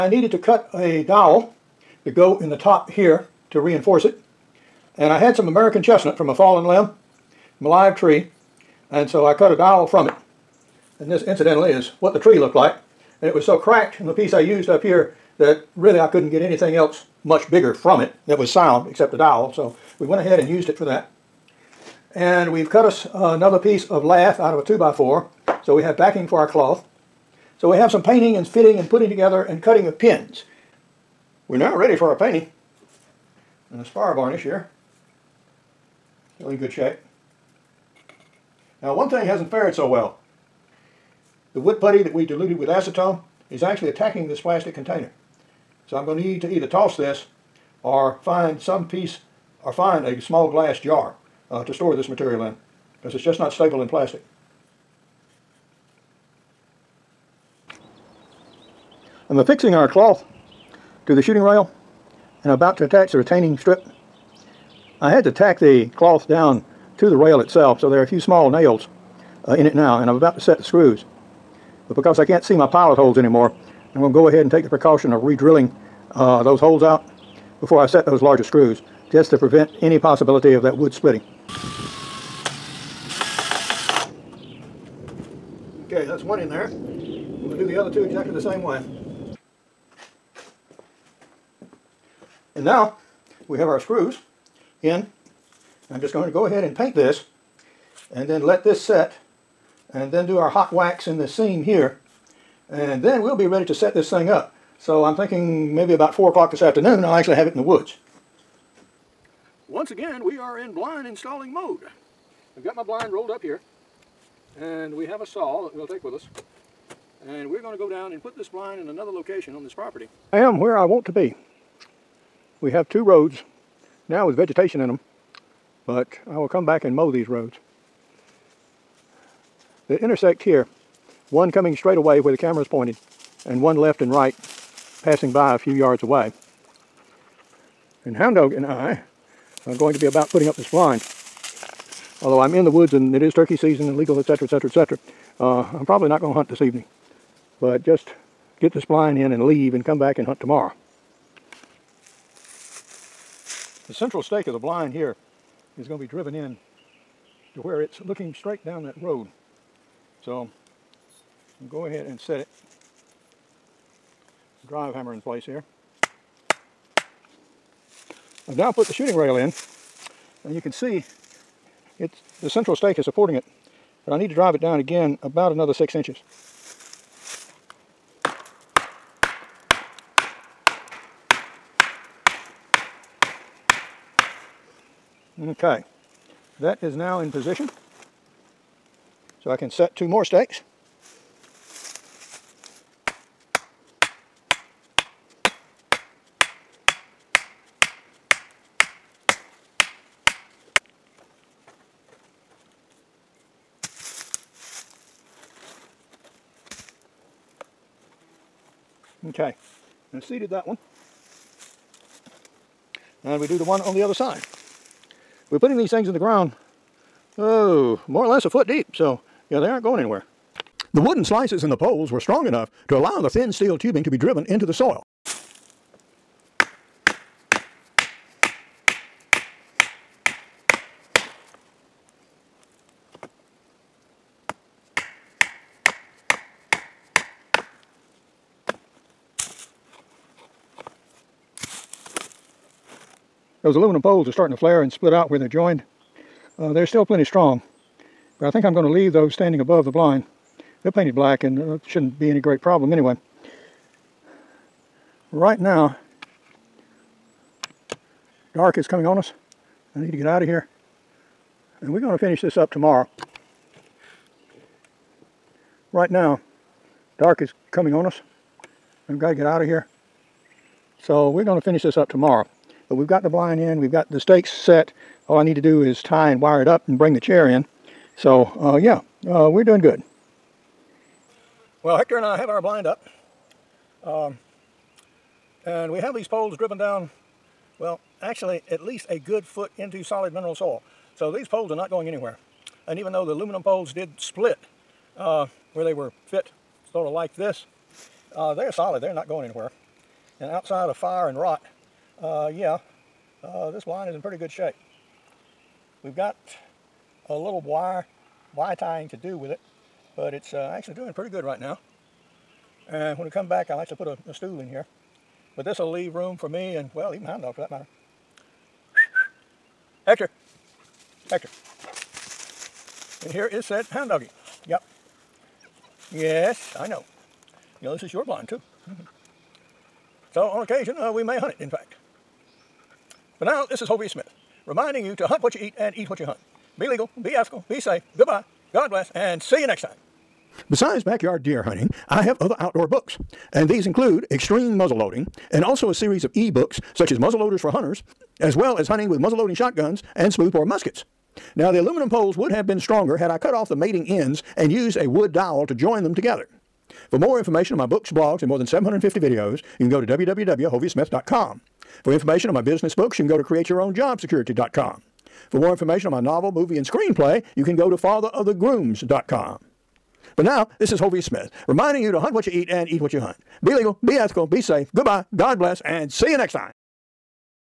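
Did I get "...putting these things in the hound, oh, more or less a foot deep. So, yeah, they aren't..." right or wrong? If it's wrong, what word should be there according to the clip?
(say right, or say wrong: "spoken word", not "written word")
wrong: "ground", not "hound".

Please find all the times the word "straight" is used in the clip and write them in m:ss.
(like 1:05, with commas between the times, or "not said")
2:11, 2:38.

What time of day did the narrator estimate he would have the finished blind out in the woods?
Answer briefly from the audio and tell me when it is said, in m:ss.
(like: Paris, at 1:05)
4 o'clock, at 1:46.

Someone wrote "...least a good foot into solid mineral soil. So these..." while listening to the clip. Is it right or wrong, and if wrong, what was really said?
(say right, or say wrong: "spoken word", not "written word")
right.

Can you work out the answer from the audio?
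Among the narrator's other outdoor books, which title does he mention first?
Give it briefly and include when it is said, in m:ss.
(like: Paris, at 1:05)
Extreme Muzzleloading, at 5:44.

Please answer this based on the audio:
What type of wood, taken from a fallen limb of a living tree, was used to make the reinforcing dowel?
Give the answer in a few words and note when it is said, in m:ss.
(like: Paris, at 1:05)
American chestnut, at 0:05.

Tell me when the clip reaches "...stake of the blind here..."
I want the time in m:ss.
2:34.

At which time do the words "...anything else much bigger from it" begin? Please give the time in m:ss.
0:16.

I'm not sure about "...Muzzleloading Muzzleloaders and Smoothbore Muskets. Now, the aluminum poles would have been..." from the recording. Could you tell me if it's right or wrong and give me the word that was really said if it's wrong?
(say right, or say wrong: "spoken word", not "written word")
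wrong: "Shotguns", not "Muzzleloaders".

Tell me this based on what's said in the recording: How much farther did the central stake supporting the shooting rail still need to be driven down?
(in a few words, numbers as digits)
6 inches.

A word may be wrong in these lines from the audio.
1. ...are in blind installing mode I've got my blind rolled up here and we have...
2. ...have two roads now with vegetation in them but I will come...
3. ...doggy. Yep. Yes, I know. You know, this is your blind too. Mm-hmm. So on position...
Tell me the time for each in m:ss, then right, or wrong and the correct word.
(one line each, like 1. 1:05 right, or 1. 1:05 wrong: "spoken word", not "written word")
1. 1:50 right
2. 2:02 right
3. 5:24 wrong: "occasion", not "position".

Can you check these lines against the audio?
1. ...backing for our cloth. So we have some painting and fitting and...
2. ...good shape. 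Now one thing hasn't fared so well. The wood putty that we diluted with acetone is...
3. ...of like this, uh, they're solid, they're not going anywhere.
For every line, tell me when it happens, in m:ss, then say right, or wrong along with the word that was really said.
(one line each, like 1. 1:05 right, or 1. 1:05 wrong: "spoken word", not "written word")
1. 0:25 right
2. 0:36 right
3. 4:57 right.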